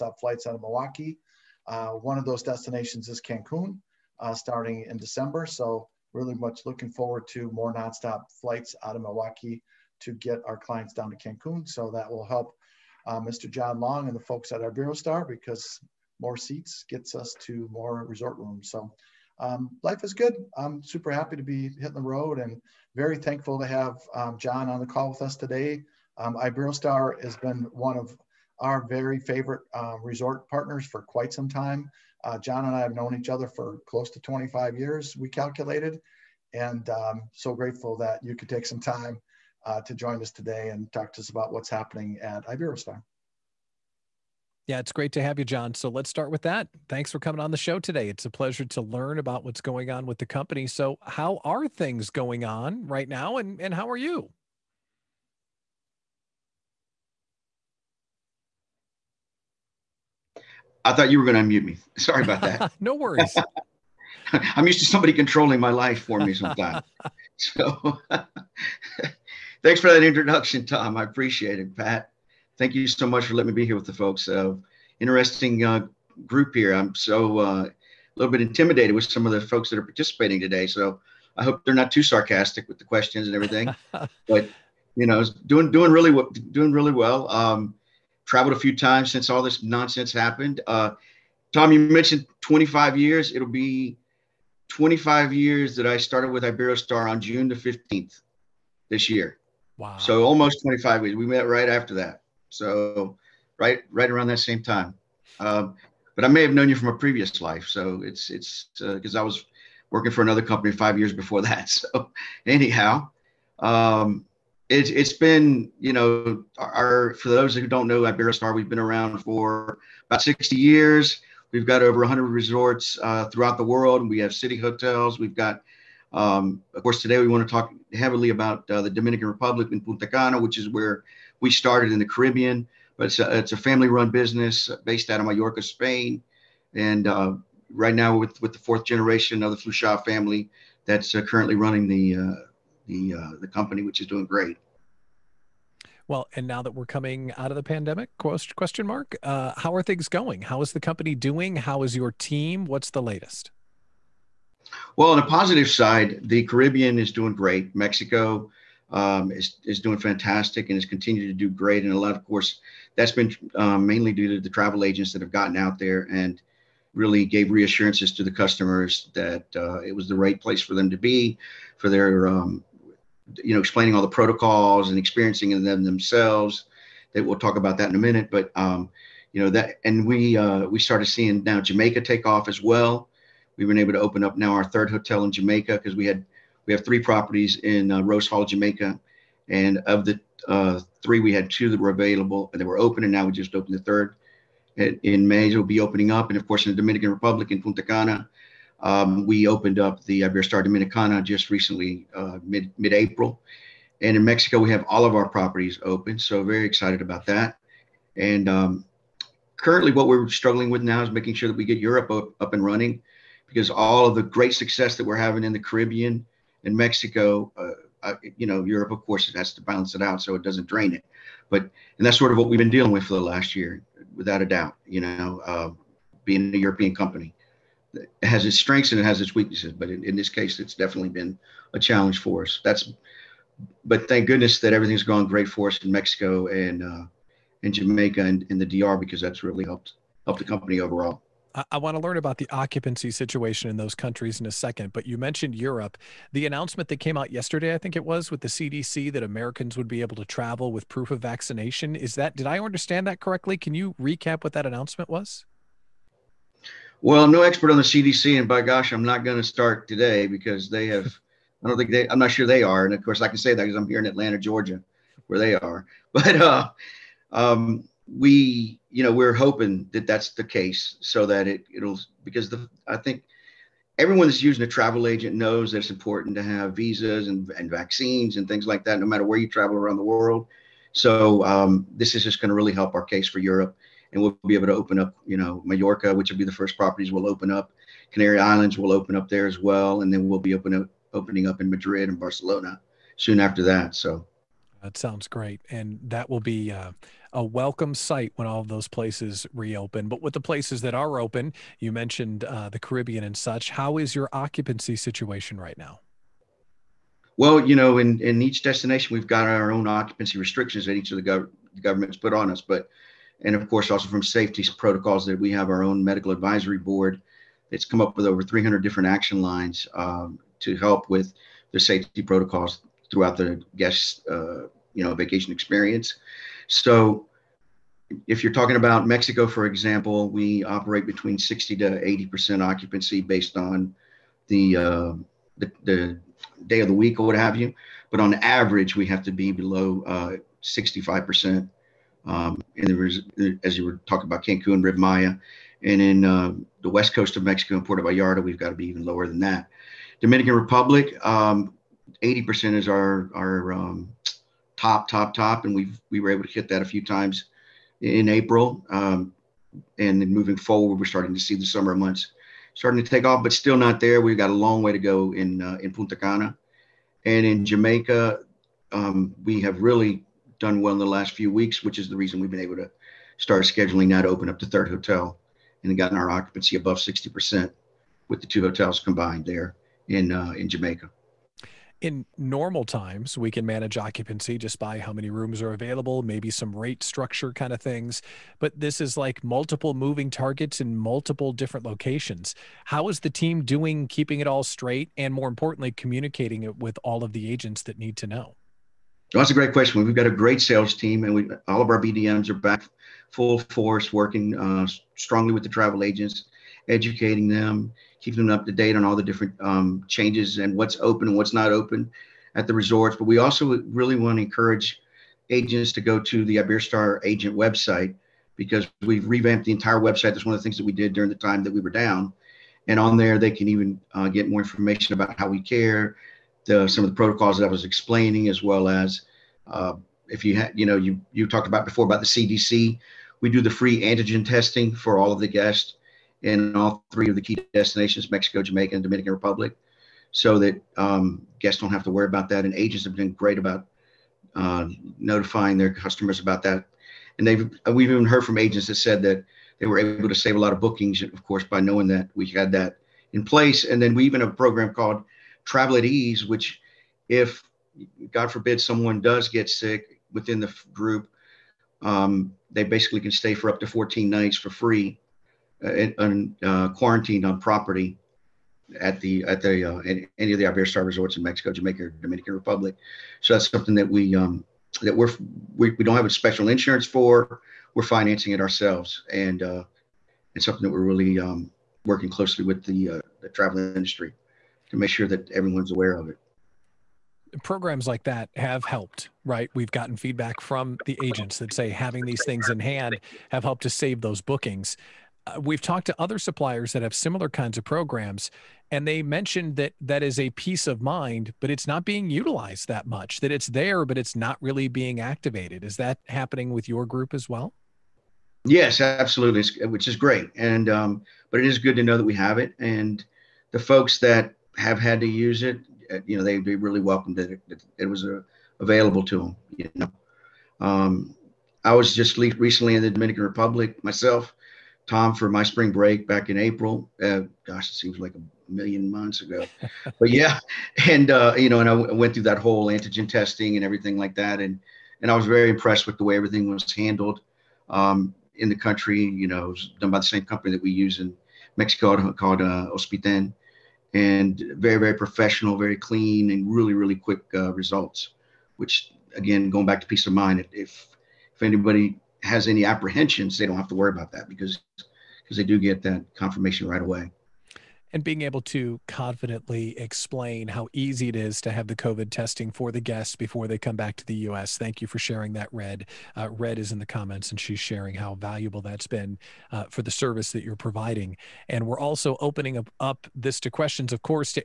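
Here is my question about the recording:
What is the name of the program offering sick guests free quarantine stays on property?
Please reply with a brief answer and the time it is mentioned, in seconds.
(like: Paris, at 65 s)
Travel at Ease, at 455 s.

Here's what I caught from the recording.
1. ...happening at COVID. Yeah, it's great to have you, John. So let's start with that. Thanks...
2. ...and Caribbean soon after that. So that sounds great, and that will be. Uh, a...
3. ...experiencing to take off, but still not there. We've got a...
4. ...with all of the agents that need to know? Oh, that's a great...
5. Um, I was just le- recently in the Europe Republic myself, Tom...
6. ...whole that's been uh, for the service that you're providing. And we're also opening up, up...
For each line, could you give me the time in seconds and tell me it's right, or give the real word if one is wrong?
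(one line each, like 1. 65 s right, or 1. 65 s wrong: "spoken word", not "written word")
1. 41 s wrong: "Iberostar", not "COVID"
2. 292 s wrong: "Barcelona", not "Caribbean"
3. 362 s wrong: "starting", not "experiencing"
4. 396 s right
5. 520 s wrong: "Dominican", not "Europe"
6. 568 s wrong: "valuable", not "whole".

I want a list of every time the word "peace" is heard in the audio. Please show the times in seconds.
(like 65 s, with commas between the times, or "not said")
500 s, 550 s.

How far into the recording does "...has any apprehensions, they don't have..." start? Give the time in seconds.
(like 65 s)
552 s.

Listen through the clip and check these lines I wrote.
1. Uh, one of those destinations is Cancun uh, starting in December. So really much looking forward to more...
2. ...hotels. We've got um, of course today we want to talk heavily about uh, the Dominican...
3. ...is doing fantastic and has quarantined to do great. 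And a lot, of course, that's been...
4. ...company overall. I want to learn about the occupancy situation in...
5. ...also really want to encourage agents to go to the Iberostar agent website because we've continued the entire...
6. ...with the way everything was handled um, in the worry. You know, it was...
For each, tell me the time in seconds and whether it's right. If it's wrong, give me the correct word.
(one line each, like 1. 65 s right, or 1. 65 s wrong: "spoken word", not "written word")
1. 1 s right
2. 124 s right
3. 159 s wrong: "continued", not "quarantined"
4. 240 s right
5. 413 s wrong: "revamped", not "continued"
6. 536 s wrong: "country", not "worry".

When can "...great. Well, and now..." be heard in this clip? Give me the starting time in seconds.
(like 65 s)
144 s.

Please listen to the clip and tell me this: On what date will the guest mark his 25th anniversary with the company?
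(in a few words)
June 15.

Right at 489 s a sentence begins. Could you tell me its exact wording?
We've gotten feedback from the agents that say having these things in hand have helped to save those bookings.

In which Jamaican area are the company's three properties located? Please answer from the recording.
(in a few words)
Rose Hall.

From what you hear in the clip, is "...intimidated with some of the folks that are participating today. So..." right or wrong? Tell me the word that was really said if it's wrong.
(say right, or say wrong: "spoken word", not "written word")
right.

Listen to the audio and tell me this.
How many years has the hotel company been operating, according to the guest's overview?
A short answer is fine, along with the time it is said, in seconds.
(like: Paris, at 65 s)
60, at 120 s.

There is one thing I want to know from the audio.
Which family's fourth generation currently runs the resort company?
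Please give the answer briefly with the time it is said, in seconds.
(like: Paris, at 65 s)
Fluxà, at 139 s.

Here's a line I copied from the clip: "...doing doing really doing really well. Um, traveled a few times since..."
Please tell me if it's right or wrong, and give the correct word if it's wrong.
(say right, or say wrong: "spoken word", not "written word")
right.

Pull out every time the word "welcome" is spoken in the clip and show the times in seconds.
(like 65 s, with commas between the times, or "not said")
297 s, 516 s.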